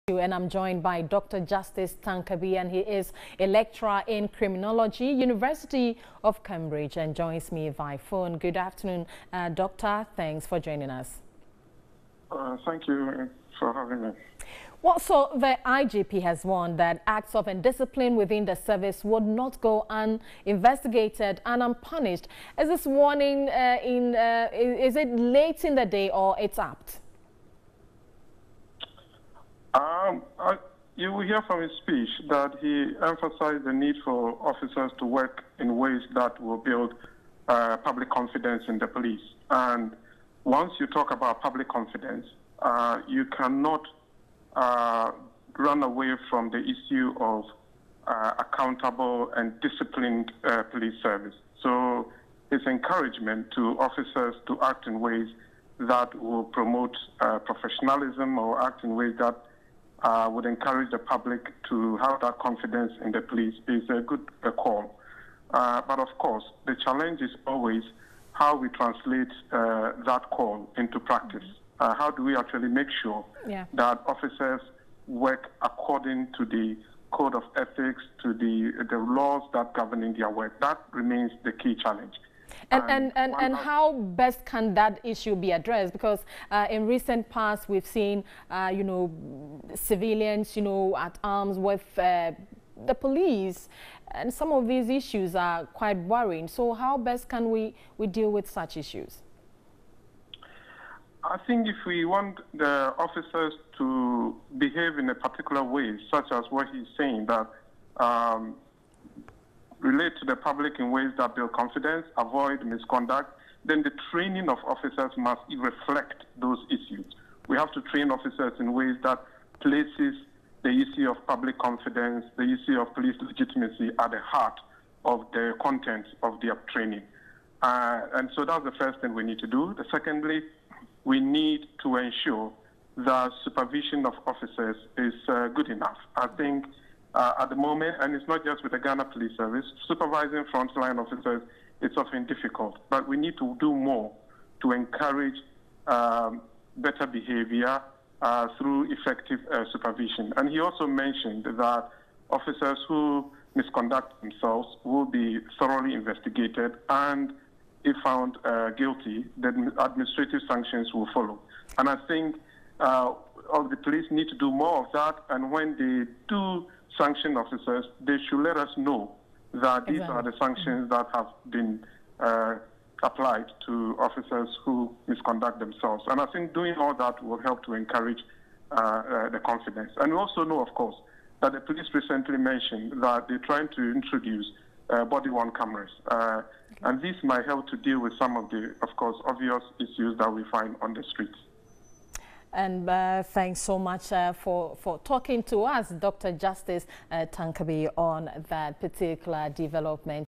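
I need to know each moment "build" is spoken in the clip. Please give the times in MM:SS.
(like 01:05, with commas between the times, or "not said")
00:36, 01:51.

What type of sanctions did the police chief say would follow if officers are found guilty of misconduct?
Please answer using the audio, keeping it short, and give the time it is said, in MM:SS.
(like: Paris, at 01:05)
Administrative sanctions, at 02:39.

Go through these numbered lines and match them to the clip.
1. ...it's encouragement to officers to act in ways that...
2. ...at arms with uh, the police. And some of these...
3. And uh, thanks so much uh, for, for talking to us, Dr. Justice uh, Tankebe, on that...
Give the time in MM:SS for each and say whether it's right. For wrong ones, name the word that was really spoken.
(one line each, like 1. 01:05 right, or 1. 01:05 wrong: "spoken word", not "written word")
1. 00:52 right
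2. 01:30 right
3. 03:12 right.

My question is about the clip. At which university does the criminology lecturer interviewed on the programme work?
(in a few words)
University of Cambridge.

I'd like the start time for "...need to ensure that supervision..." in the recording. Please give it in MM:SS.
02:11.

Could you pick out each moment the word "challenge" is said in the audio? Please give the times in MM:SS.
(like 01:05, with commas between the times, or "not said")
01:06, 01:21.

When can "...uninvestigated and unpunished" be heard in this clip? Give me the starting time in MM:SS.
00:19.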